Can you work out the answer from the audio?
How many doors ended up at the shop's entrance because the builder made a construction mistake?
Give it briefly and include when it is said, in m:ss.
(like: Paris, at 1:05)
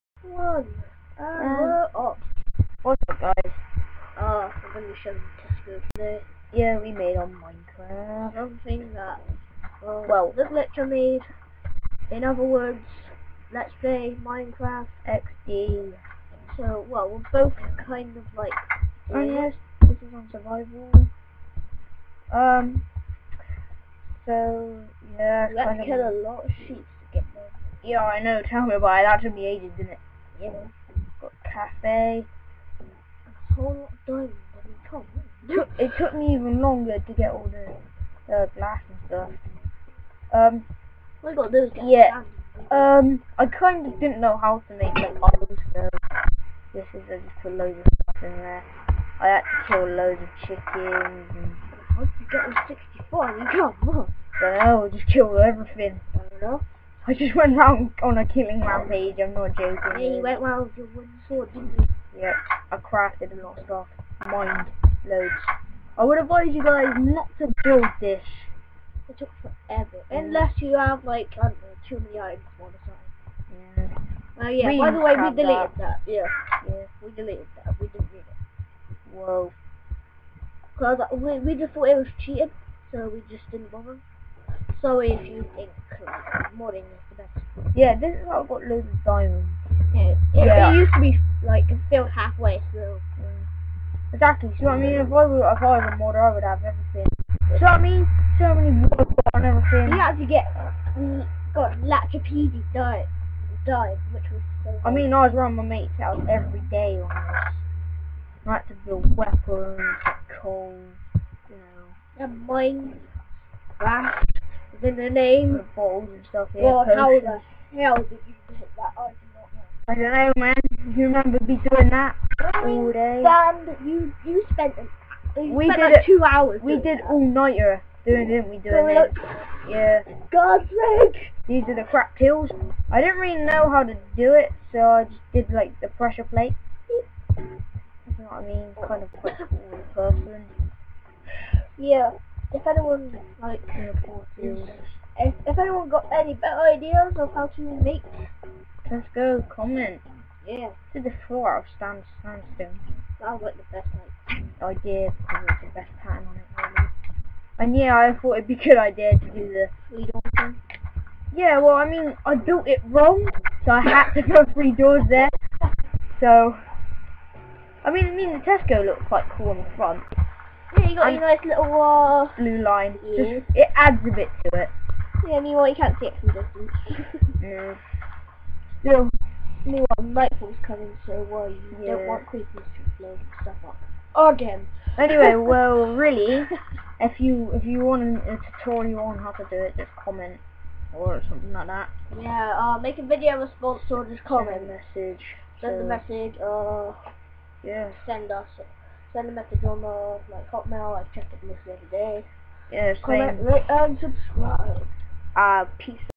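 3, at 2:44.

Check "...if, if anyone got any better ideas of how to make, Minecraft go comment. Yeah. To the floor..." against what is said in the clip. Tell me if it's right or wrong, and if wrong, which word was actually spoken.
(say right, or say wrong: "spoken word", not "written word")
wrong: "Tesco", not "Minecraft".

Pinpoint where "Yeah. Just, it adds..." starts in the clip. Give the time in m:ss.
2:53.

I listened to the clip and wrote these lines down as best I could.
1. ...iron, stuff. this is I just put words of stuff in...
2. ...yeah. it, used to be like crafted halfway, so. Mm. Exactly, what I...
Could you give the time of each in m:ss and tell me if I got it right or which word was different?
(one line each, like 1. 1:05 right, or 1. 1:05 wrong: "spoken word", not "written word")
1. 0:45 wrong: "loads", not "words"
2. 1:30 wrong: "filled", not "crafted".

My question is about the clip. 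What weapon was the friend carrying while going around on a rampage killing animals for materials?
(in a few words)
wooden sword.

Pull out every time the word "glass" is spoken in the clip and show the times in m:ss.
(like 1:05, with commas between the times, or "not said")
0:38, 1:53.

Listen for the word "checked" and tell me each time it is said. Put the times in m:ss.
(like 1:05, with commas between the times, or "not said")
3:21.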